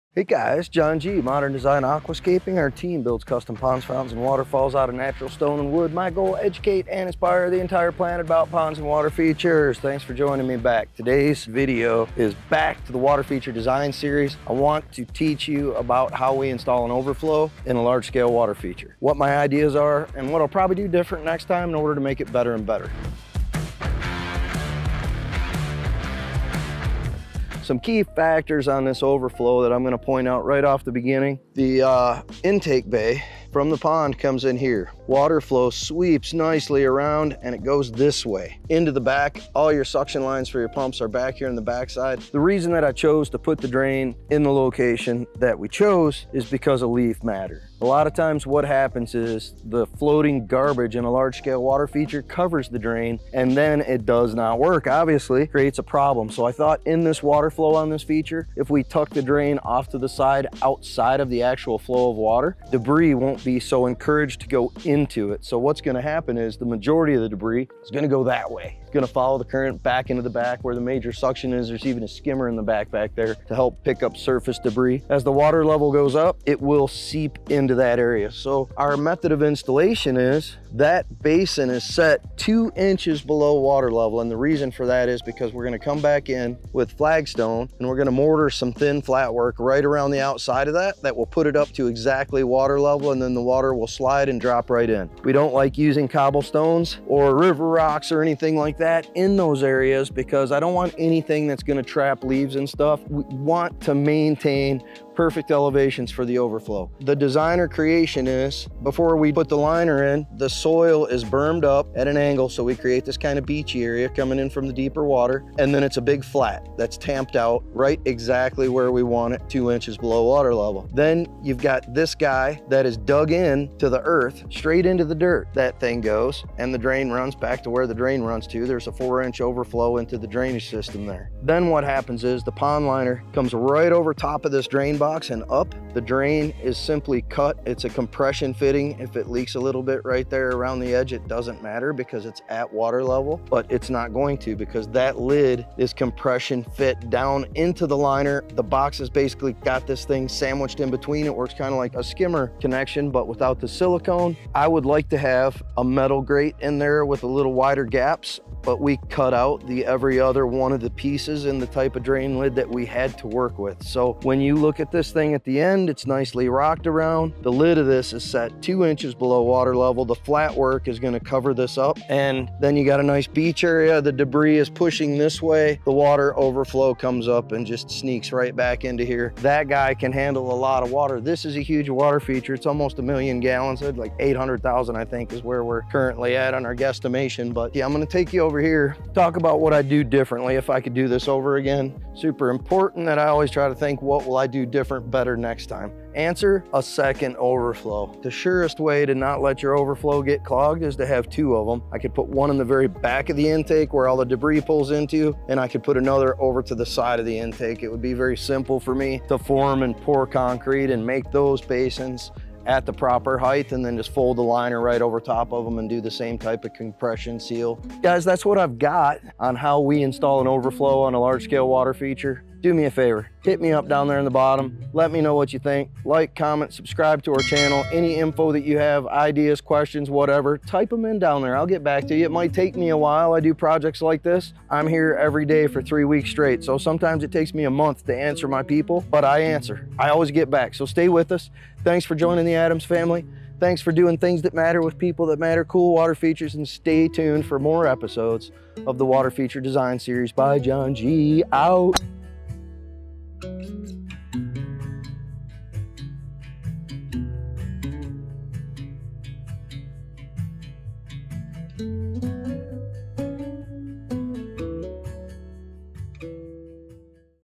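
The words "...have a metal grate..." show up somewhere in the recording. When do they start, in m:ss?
2:35.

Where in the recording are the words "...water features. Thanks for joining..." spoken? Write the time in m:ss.
0:08.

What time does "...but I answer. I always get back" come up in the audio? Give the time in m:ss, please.
3:59.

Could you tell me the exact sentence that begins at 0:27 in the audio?
Some key factors on this overflow that I'm gonna point out right off the beginning.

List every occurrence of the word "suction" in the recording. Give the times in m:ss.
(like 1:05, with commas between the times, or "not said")
0:39, 1:11.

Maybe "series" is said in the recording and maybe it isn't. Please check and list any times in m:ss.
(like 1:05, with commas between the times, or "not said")
0:13, 4:09.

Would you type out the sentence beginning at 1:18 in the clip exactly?
So our method of installation is that basin is set two inches below water level.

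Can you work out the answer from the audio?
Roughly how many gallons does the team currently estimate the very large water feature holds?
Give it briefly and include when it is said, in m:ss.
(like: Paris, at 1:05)
800,000, at 3:04.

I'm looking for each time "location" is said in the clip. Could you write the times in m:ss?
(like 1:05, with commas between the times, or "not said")
0:44.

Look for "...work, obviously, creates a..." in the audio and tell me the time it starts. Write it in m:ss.
0:54.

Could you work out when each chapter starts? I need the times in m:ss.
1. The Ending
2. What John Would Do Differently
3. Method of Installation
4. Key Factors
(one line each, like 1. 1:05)
1. 3:38
2. 3:08
3. 1:18
4. 0:27.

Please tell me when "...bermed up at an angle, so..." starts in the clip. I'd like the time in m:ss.
1:51.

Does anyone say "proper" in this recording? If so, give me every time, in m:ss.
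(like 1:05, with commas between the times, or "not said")
3:32.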